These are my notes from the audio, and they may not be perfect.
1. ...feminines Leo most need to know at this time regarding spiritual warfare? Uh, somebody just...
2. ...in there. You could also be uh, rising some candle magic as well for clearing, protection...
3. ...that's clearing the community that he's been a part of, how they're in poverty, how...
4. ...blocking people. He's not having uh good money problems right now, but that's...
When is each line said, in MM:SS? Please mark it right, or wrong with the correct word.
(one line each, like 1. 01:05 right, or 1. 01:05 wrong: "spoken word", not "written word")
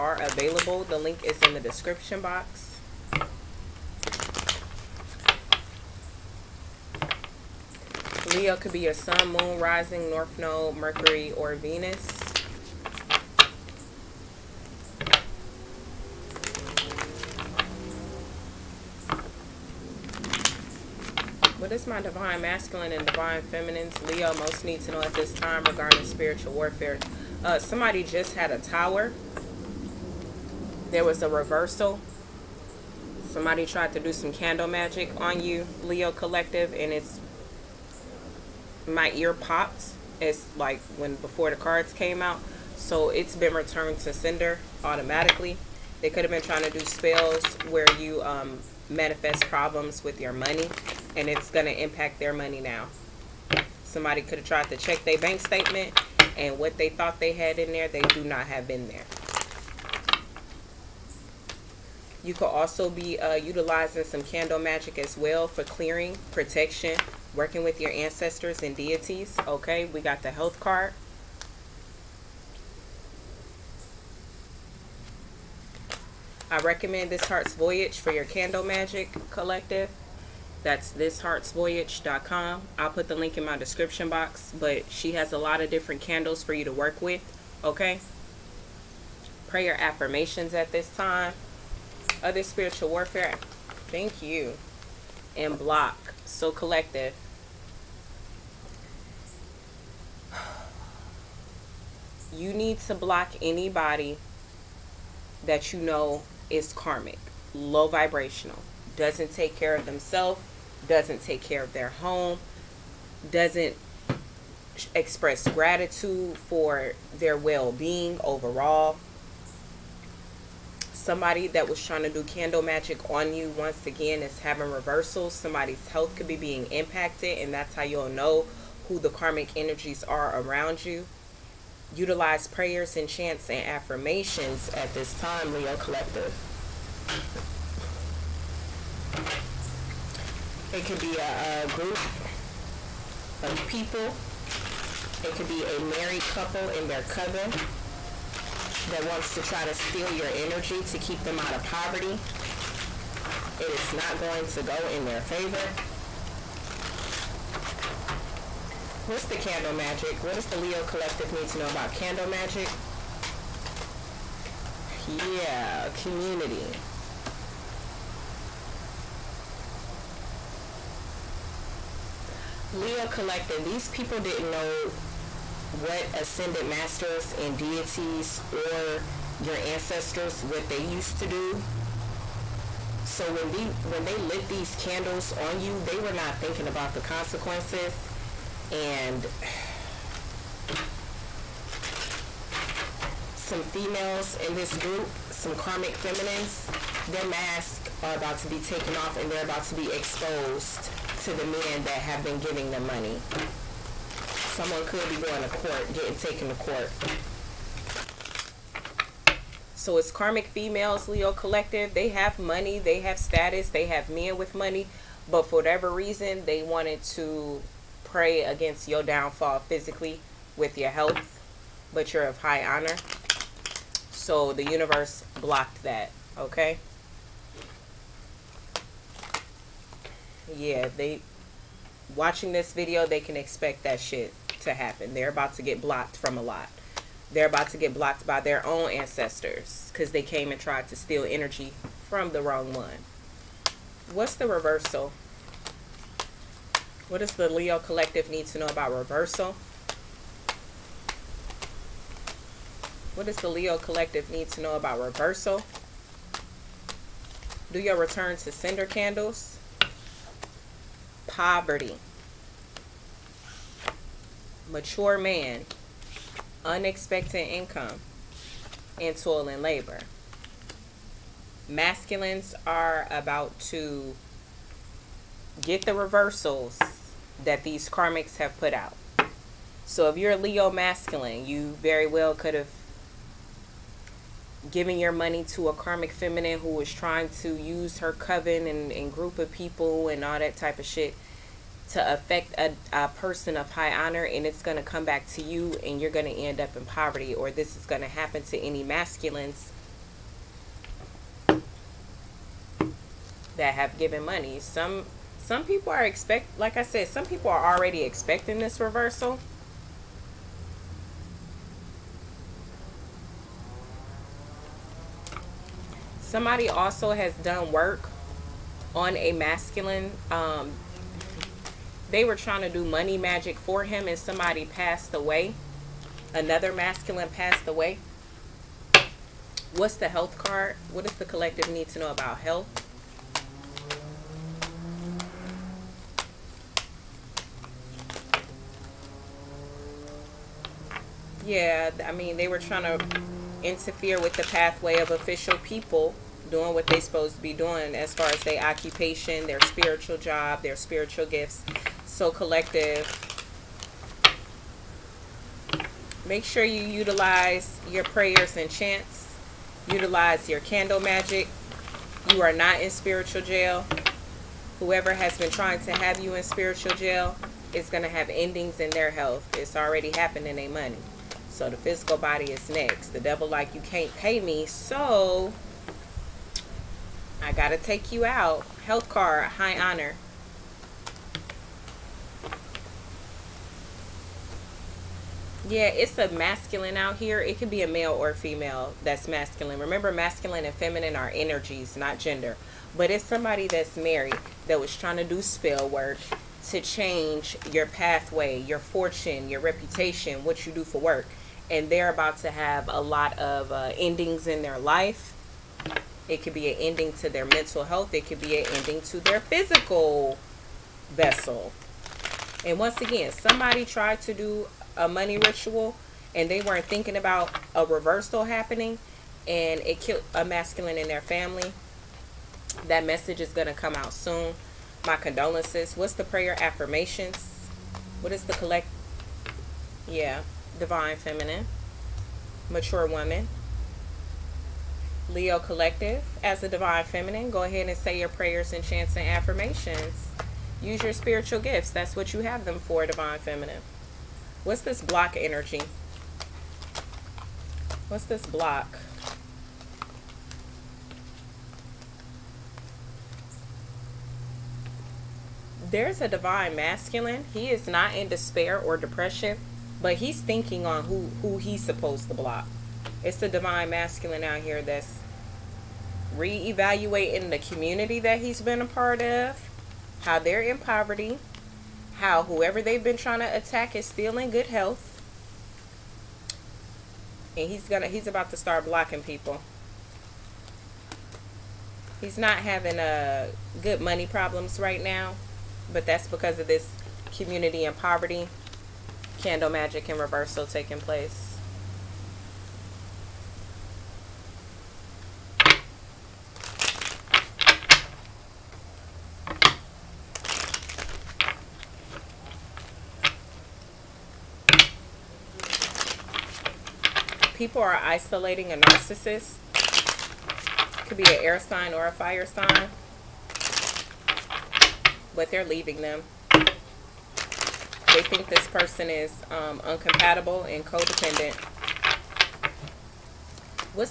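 1. 00:23 right
2. 00:58 wrong: "utilizing", not "rising"
3. 07:44 wrong: "reevaluating", not "clearing"
4. 07:58 right.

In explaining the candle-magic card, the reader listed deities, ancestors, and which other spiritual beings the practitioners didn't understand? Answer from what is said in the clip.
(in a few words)
Ascended masters.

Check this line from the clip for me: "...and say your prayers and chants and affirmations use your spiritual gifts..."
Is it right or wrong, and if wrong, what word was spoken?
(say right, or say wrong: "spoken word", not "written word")
right.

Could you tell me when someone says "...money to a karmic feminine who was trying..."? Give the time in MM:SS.
04:45.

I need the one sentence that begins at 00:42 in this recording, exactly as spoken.
So it's been returned to sender automatically.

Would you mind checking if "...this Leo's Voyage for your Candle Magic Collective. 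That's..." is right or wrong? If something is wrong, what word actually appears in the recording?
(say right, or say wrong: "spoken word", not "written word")
wrong: "Heart", not "Leo".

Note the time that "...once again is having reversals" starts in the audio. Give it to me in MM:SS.
02:03.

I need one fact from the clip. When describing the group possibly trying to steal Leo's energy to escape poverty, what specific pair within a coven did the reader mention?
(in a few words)
A married couple.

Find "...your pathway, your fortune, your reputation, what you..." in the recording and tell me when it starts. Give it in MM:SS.
06:37.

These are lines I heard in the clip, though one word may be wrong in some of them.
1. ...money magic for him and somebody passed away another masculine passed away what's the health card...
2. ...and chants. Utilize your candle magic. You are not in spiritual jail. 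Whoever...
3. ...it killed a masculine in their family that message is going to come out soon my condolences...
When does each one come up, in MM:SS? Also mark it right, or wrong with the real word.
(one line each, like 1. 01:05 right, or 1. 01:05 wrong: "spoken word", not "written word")
1. 05:22 right
2. 05:58 right
3. 06:59 right.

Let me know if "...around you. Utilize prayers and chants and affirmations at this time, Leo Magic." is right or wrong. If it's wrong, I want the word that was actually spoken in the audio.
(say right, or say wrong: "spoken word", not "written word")
wrong: "Collective", not "Magic".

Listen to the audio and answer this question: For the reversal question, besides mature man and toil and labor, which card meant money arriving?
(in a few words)
Unexpected income.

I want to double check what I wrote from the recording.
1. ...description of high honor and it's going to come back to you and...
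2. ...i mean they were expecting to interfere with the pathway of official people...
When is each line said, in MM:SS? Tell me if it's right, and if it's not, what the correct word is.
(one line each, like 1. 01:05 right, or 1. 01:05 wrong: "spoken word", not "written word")
1. 04:53 wrong: "person", not "description"
2. 05:42 wrong: "trying", not "expecting".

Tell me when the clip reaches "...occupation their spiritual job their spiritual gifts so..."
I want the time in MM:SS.
05:48.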